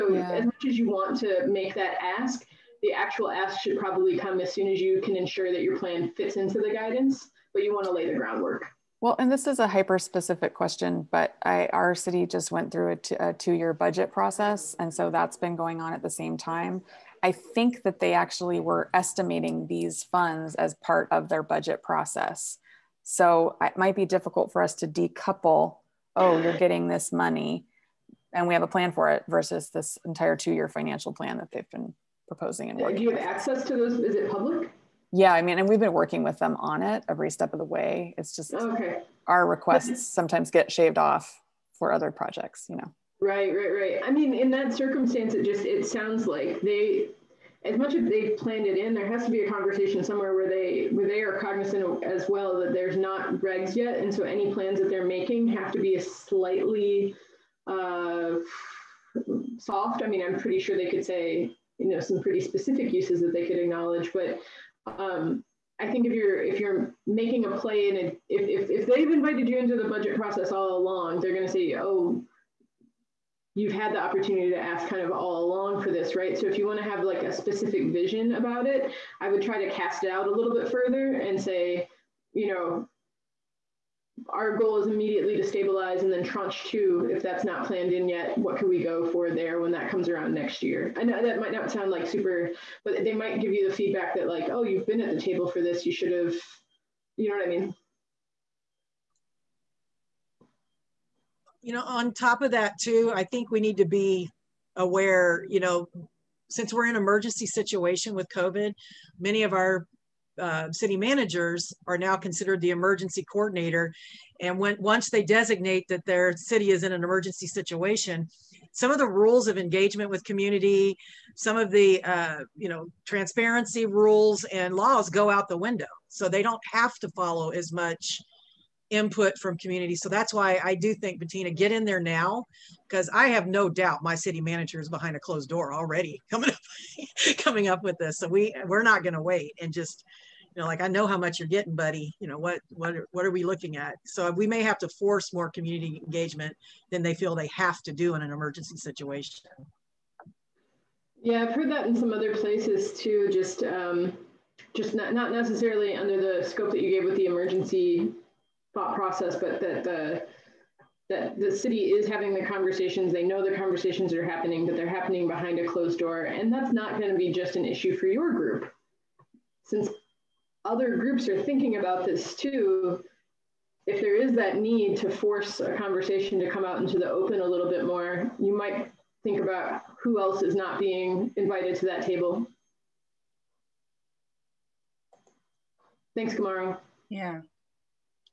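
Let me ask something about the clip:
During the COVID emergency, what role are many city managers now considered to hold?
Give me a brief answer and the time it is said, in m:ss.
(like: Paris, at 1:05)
emergency coordinator, at 1:52.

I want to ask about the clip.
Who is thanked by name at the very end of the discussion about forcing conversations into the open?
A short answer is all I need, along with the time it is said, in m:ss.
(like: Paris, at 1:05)
Kamara, at 3:06.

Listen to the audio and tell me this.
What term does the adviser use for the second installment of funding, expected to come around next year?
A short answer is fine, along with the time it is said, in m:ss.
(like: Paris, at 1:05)
tranche two, at 1:26.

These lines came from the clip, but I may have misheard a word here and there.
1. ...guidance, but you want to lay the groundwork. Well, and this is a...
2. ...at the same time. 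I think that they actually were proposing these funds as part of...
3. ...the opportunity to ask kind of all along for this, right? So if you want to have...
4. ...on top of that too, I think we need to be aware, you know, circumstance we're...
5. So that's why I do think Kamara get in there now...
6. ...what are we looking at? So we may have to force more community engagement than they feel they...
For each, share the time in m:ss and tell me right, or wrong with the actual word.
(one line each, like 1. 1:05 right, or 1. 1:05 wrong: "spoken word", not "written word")
1. 0:06 right
2. 0:15 wrong: "estimating", not "proposing"
3. 1:13 right
4. 1:41 wrong: "since", not "circumstance"
5. 2:09 wrong: "Bettina", not "Kamara"
6. 2:23 right.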